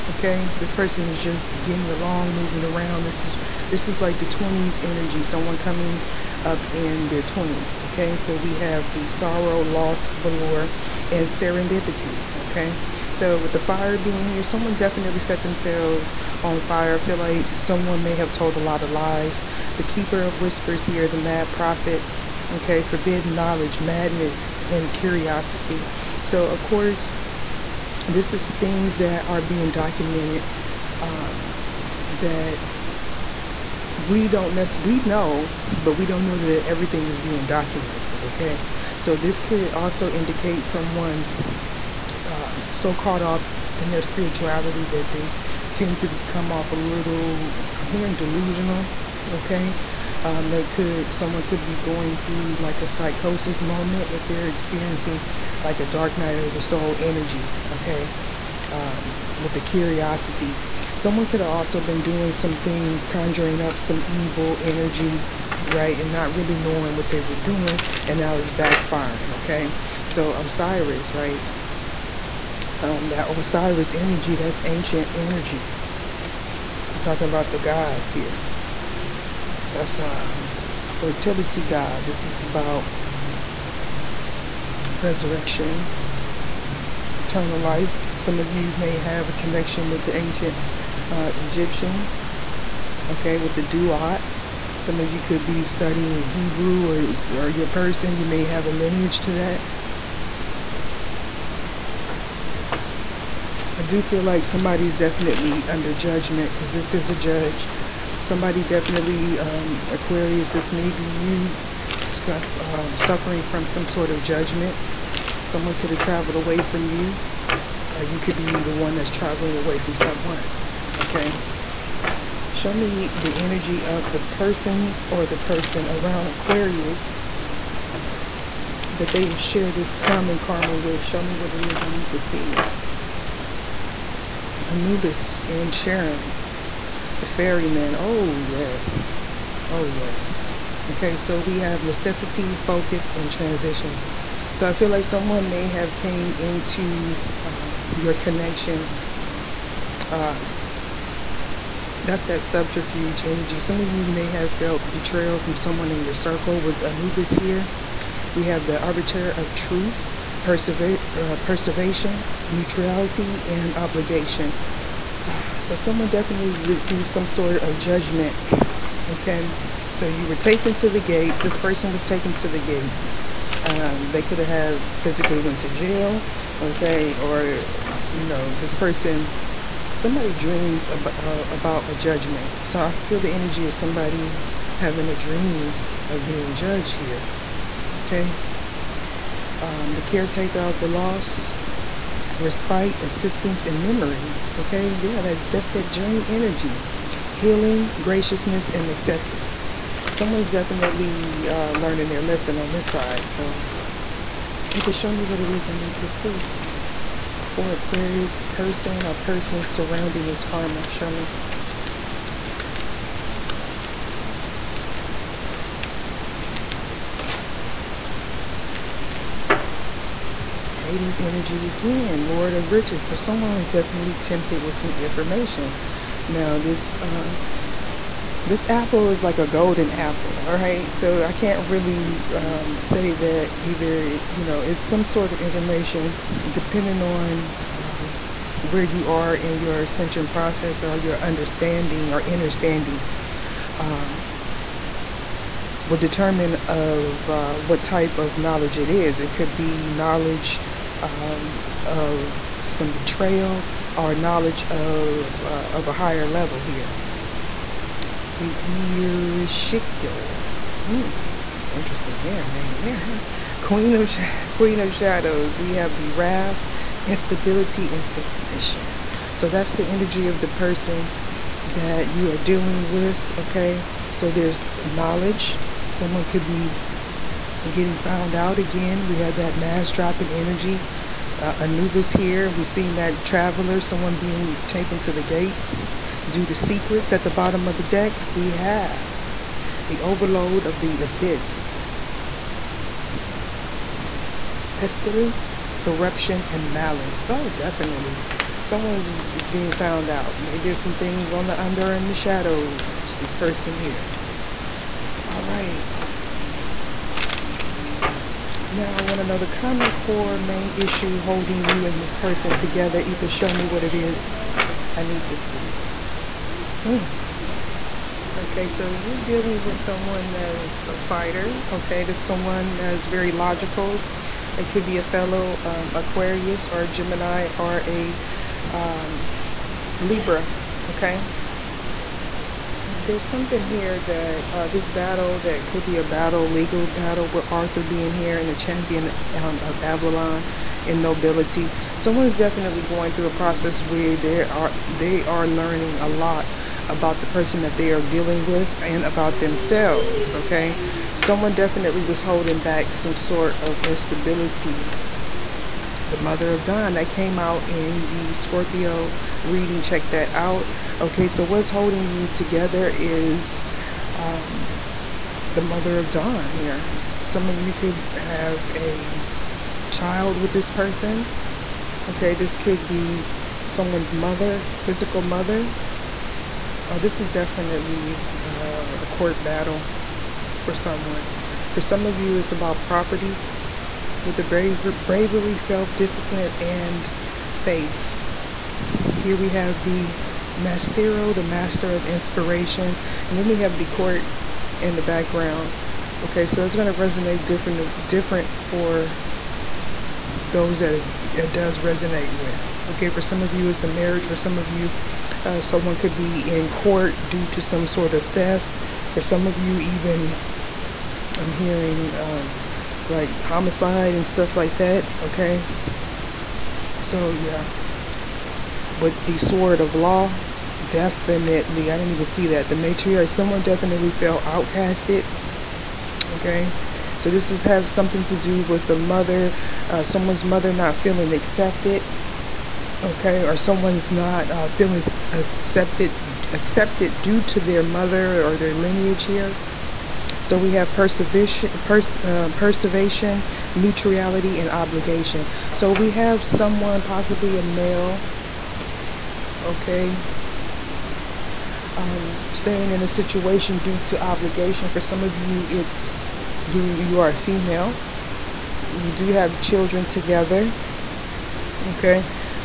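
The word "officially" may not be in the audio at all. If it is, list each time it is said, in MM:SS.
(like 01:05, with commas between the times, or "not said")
not said.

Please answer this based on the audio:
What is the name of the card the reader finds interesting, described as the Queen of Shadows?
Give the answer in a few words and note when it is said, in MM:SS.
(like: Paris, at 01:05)
Ereshkigal, at 04:18.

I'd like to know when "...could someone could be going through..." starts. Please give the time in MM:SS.
00:50.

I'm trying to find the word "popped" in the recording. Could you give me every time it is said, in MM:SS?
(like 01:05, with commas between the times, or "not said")
not said.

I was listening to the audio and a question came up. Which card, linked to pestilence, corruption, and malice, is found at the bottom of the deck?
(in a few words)
Overlord of the Abyss.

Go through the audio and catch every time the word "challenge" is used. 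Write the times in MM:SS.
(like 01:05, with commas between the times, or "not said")
not said.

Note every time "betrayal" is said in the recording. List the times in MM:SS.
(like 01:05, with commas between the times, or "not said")
02:34, 04:12.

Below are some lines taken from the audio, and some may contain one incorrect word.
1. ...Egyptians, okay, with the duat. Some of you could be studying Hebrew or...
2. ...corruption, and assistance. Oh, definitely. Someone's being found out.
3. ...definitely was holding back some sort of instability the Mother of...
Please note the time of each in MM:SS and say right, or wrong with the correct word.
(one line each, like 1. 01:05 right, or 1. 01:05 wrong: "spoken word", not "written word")
1. 01:31 right
2. 04:55 wrong: "malice", not "assistance"
3. 05:51 right.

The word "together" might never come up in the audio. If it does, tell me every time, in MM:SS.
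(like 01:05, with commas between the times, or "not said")
05:12, 06:02, 07:40.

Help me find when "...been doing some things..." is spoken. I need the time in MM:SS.
01:01.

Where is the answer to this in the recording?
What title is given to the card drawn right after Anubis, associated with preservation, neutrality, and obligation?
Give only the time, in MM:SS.
02:38.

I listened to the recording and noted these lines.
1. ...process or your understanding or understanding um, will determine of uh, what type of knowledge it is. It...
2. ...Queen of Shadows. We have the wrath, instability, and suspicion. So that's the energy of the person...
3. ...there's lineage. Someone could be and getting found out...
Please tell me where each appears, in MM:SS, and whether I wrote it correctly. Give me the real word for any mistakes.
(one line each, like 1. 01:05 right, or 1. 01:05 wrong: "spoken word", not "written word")
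1. 04:00 right
2. 04:24 right
3. 04:34 wrong: "knowledge", not "lineage".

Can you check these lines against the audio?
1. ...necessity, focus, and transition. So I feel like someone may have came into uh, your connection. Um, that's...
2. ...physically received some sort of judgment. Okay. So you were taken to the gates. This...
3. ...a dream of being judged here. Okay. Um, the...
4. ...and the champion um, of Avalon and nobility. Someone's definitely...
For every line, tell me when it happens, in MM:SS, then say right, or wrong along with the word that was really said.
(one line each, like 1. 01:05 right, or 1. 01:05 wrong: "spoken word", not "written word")
1. 02:21 right
2. 02:46 wrong: "definitely", not "physically"
3. 03:05 right
4. 05:38 right.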